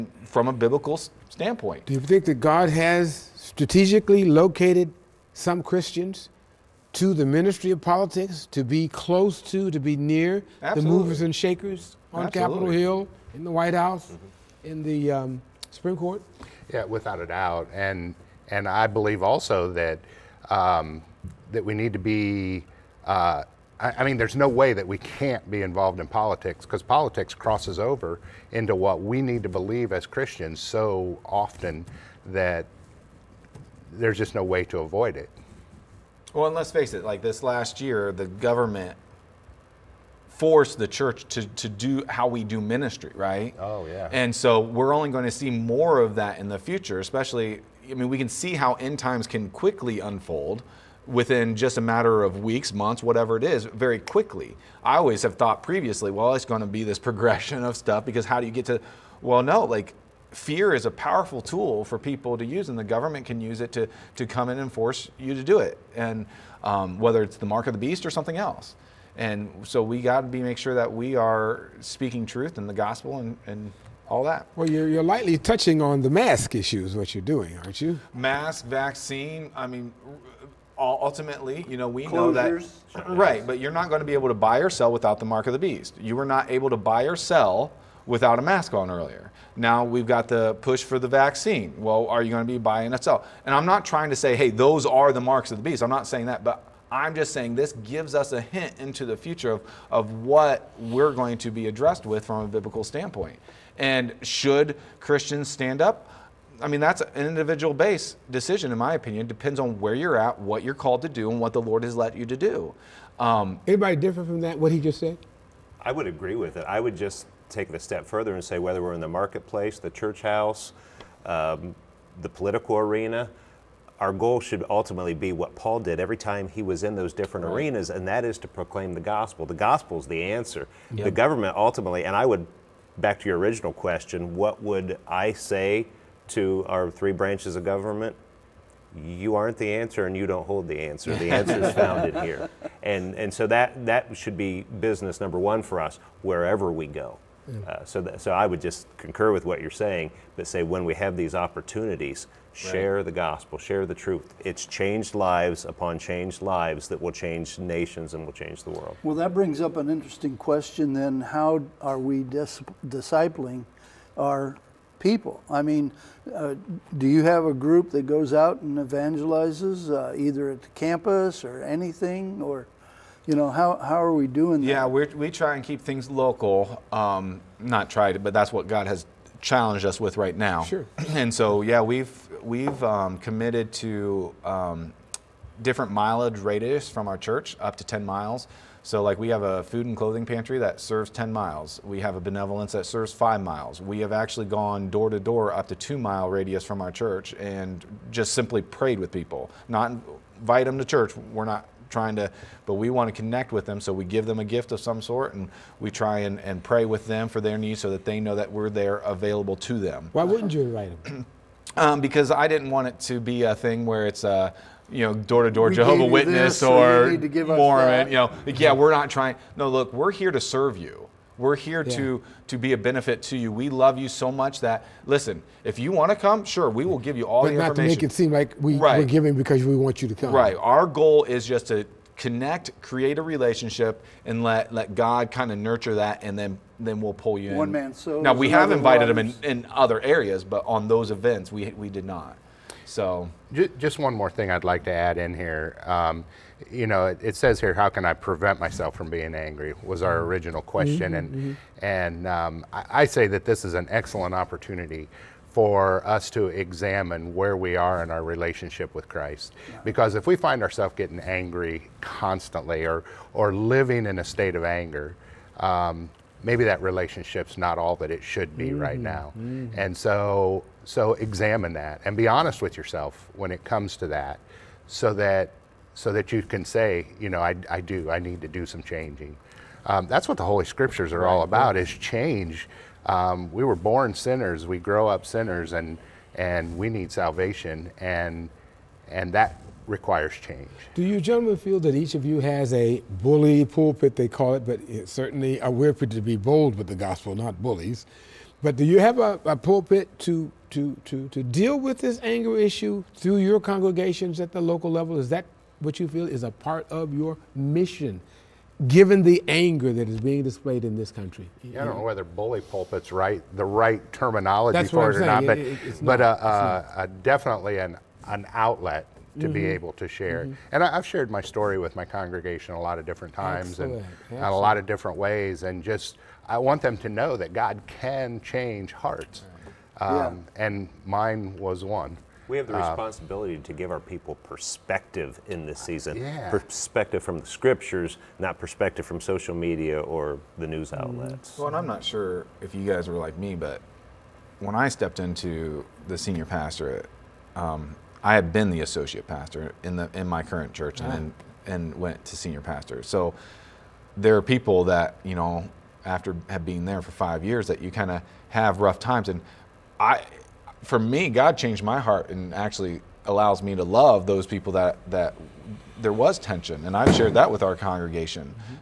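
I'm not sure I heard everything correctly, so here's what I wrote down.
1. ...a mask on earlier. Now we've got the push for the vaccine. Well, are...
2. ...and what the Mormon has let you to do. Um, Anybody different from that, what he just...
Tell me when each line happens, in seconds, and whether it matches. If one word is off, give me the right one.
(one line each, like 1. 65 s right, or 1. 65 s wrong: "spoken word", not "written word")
1. 88 s right
2. 111 s wrong: "Lord", not "Mormon".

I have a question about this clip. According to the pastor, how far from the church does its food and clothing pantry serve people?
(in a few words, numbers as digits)
10 miles.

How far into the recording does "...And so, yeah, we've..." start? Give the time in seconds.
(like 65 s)
181 s.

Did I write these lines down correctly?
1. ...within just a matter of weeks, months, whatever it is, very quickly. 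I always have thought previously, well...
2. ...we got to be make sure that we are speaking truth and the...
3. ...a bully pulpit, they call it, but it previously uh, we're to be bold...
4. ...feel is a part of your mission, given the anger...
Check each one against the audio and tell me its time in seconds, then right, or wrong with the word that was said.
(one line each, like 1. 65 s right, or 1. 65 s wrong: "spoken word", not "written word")
1. 51 s right
2. 69 s right
3. 292 s wrong: "certainly", not "previously"
4. 306 s right.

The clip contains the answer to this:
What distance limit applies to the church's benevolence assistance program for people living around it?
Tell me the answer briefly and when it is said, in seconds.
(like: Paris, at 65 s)
5 miles, at 193 s.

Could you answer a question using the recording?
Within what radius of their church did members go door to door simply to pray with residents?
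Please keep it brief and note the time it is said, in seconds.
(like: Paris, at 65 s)
2 miles, at 195 s.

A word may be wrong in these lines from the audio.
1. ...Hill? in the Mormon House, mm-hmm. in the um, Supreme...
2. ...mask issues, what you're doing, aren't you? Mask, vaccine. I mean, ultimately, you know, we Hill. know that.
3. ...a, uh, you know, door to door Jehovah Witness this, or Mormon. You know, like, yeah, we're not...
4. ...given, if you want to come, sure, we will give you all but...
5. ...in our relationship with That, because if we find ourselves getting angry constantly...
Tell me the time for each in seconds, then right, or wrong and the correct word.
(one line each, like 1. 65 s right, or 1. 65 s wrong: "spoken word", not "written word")
1. 12 s wrong: "White", not "Mormon"
2. 76 s wrong: "Closures", not "Hill"
3. 214 s right
4. 225 s wrong: "listen", not "given"
5. 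258 s wrong: "Christ", not "That".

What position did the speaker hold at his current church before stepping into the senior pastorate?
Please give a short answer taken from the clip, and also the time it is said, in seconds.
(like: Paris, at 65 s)
Associate pastor, at 348 s.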